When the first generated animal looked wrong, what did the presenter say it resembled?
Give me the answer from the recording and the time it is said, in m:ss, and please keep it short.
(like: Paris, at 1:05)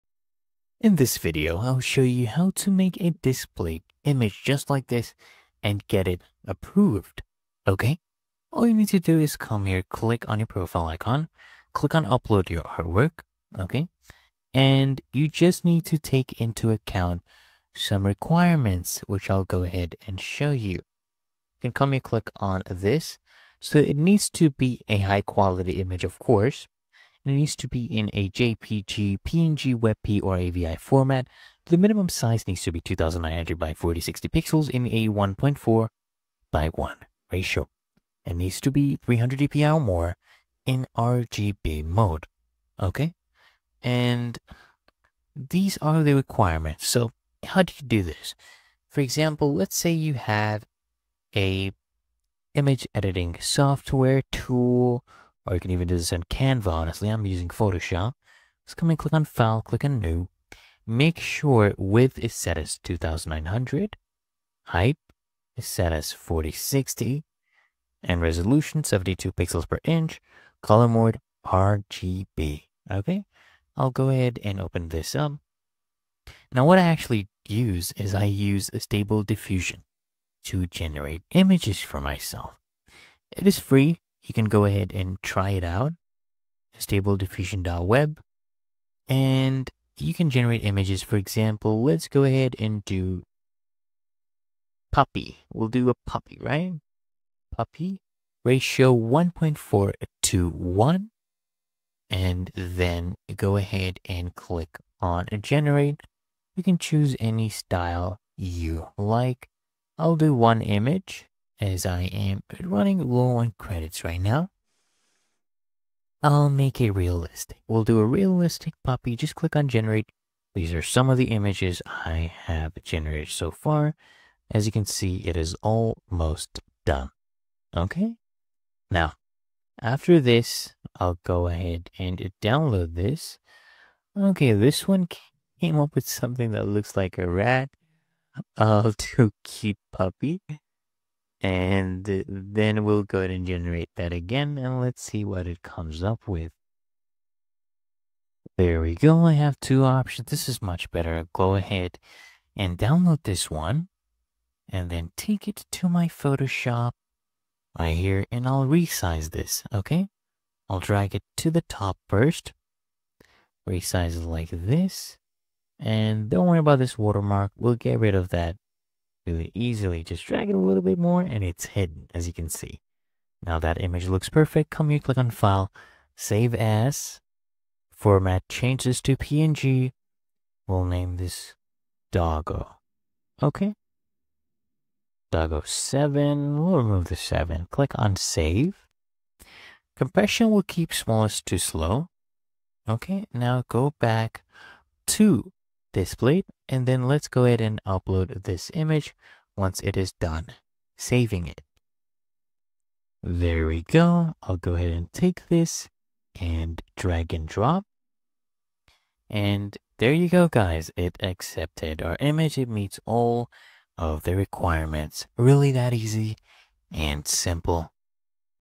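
a rat, at 2:17.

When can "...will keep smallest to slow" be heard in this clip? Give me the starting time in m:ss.
3:10.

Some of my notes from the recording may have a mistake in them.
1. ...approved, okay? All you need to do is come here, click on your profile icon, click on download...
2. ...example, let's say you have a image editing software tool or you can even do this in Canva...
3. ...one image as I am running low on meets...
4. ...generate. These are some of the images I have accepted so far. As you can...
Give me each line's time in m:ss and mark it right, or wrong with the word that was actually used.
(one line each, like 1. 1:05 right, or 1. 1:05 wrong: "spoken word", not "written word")
1. 0:06 wrong: "upload", not "download"
2. 0:49 right
3. 1:50 wrong: "credits", not "meets"
4. 1:59 wrong: "generated", not "accepted".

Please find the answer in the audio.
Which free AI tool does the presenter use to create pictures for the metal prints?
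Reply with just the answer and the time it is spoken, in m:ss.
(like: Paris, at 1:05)
Stable Diffusion, at 1:18.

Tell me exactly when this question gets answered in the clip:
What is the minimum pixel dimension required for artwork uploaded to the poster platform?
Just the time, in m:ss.
0:32.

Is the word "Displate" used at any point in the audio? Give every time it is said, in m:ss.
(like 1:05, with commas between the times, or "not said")
0:03, 3:15.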